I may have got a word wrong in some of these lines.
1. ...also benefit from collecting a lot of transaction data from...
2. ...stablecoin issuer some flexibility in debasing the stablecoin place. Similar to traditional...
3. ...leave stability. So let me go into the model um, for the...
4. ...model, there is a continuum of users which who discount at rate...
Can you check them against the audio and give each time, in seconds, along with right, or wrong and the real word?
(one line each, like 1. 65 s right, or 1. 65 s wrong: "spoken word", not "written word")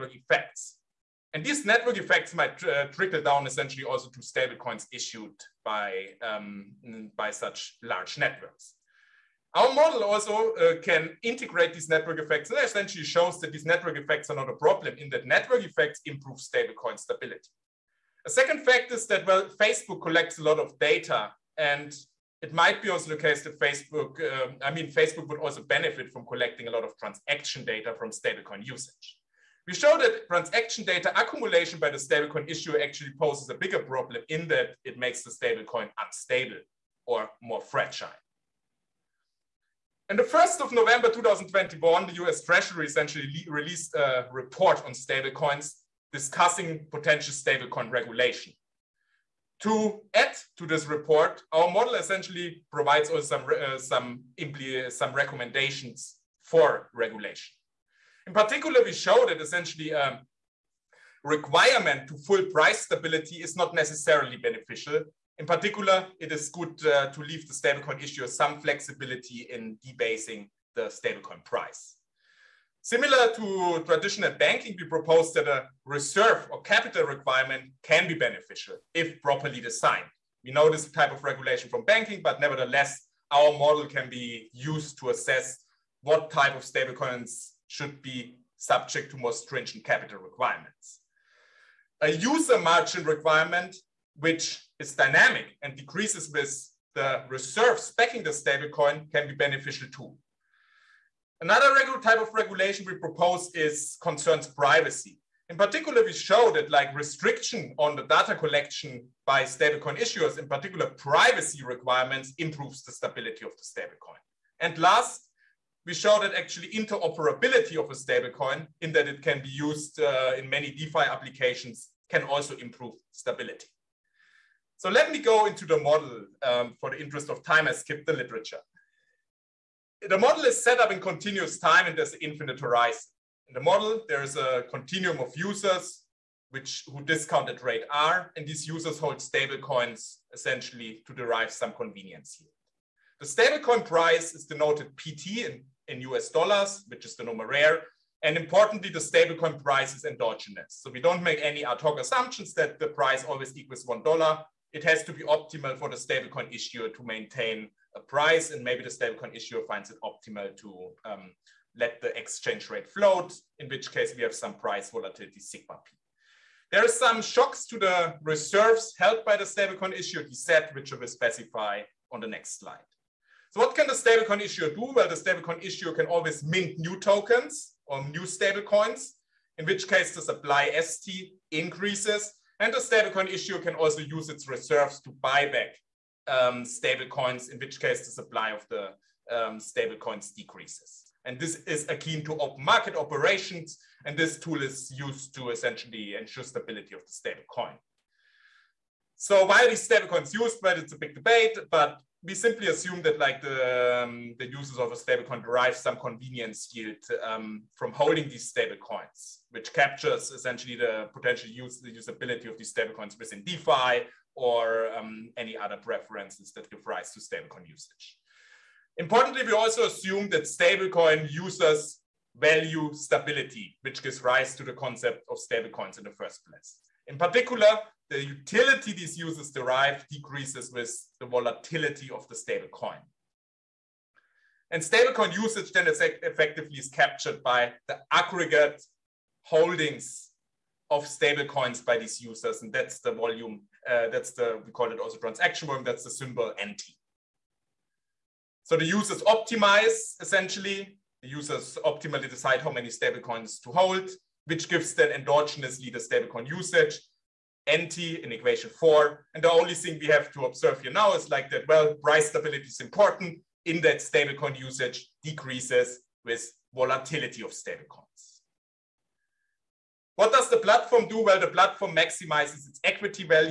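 1. 25 s right
2. 67 s wrong: "price", not "place"
3. 122 s wrong: "improve", not "leave"
4. 133 s right.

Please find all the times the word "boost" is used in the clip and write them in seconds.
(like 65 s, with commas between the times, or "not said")
not said.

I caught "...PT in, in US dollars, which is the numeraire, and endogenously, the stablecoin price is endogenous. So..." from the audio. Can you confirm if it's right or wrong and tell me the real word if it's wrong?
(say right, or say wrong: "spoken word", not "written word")
wrong: "importantly", not "endogenously".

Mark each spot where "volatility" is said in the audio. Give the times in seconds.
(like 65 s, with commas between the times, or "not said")
164 s, 231 s, 266 s.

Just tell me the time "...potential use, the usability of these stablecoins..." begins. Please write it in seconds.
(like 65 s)
211 s.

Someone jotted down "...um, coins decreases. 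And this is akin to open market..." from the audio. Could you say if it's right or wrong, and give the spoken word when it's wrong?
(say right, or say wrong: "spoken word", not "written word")
wrong: "stablecoins", not "coins".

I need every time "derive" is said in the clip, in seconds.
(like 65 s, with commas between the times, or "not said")
141 s, 205 s, 229 s.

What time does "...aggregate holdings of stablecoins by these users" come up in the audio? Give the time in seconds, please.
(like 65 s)
238 s.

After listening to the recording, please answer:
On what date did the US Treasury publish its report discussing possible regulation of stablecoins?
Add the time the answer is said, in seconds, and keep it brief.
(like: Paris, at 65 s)
1 November 2021, at 40 s.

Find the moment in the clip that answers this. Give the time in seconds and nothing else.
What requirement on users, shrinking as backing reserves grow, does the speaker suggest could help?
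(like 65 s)
92 s.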